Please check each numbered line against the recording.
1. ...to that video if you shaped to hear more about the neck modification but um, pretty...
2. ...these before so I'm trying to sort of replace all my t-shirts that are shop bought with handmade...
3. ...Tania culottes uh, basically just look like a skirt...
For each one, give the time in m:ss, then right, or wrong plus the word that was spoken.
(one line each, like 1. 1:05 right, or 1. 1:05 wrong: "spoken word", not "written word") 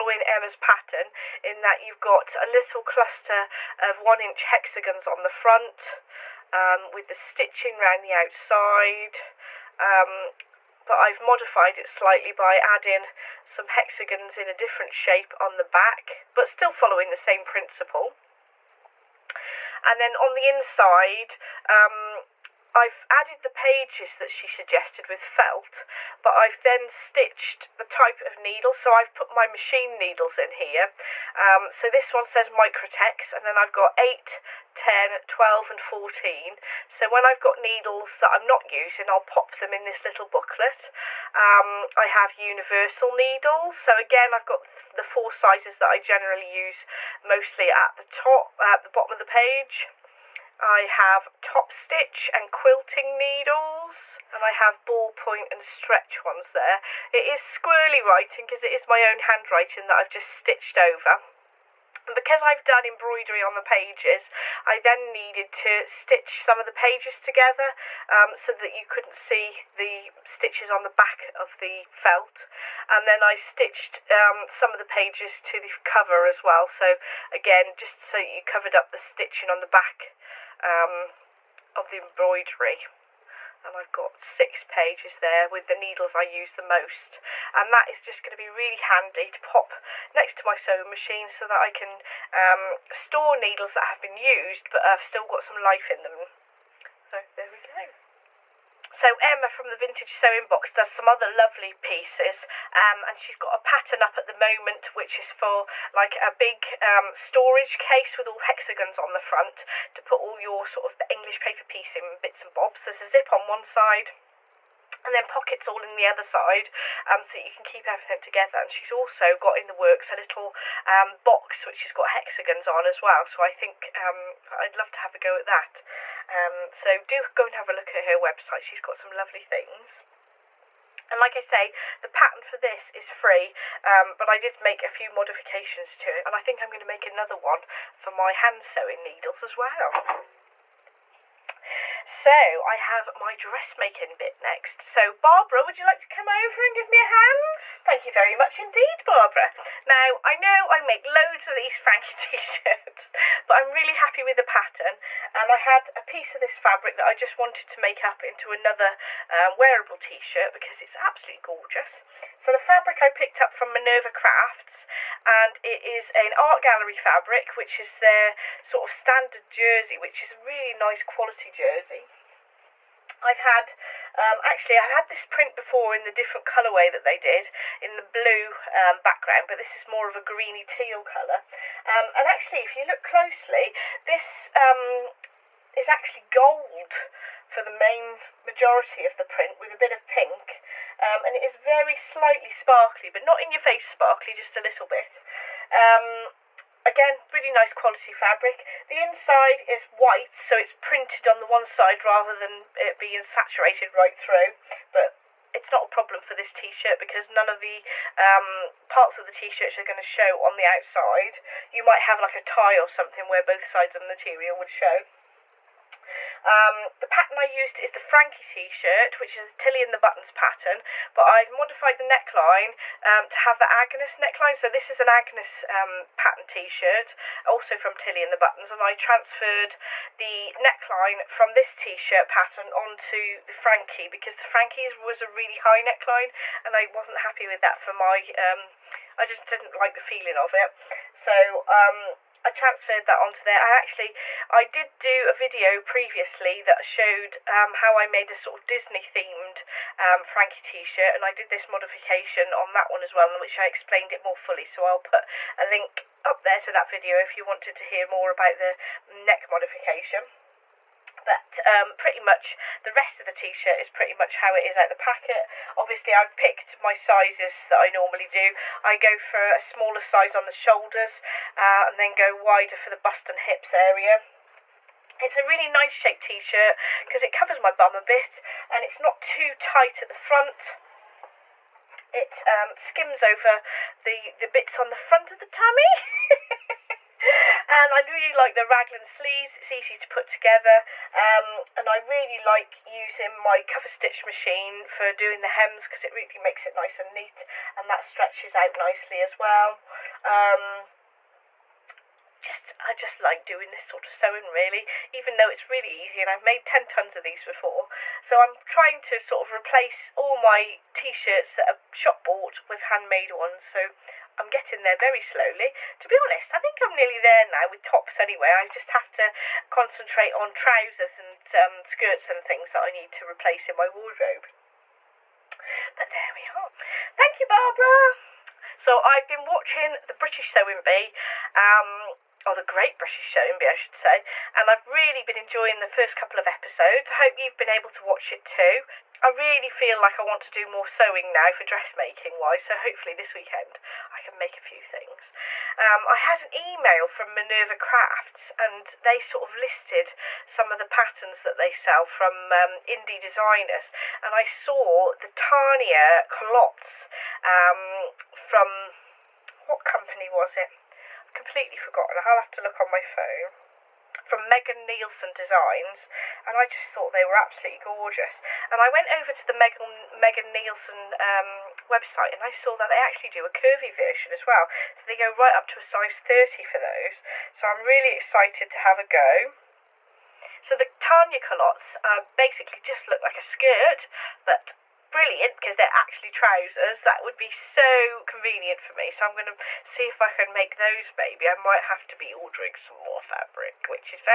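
1. 4:16 wrong: "wanted", not "shaped"
2. 5:07 right
3. 6:20 right.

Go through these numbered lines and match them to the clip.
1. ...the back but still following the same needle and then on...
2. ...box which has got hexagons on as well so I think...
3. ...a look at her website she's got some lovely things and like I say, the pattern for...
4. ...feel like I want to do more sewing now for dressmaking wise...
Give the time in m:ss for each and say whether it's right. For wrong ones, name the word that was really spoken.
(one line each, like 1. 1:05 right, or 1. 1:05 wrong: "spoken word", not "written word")
1. 0:15 wrong: "principle", not "needle"
2. 2:01 right
3. 2:07 right
4. 5:39 right.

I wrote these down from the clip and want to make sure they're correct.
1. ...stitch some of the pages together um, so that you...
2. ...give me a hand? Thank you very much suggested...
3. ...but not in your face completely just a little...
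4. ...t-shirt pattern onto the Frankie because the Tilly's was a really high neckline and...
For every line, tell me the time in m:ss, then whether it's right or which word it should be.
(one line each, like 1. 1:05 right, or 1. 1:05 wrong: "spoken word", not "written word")
1. 1:05 right
2. 2:26 wrong: "indeed", not "suggested"
3. 3:13 wrong: "sparkly", not "completely"
4. 3:51 wrong: "Frankie", not "Tilly".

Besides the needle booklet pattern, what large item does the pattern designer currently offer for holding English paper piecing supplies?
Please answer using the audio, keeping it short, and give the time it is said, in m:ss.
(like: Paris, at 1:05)
storage case, at 1:47.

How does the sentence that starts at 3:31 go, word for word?
You might have like a tie or something where both sides of the material would show.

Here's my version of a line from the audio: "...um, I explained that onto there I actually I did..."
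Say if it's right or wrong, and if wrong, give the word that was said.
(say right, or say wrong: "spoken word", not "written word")
wrong: "transferred", not "explained".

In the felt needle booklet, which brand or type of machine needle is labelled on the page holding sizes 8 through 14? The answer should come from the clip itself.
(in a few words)
Microtex.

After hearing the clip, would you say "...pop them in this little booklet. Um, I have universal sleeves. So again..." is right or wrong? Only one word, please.
wrong.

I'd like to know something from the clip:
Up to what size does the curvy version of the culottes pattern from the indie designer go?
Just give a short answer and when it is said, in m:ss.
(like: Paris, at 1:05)
30, at 6:15.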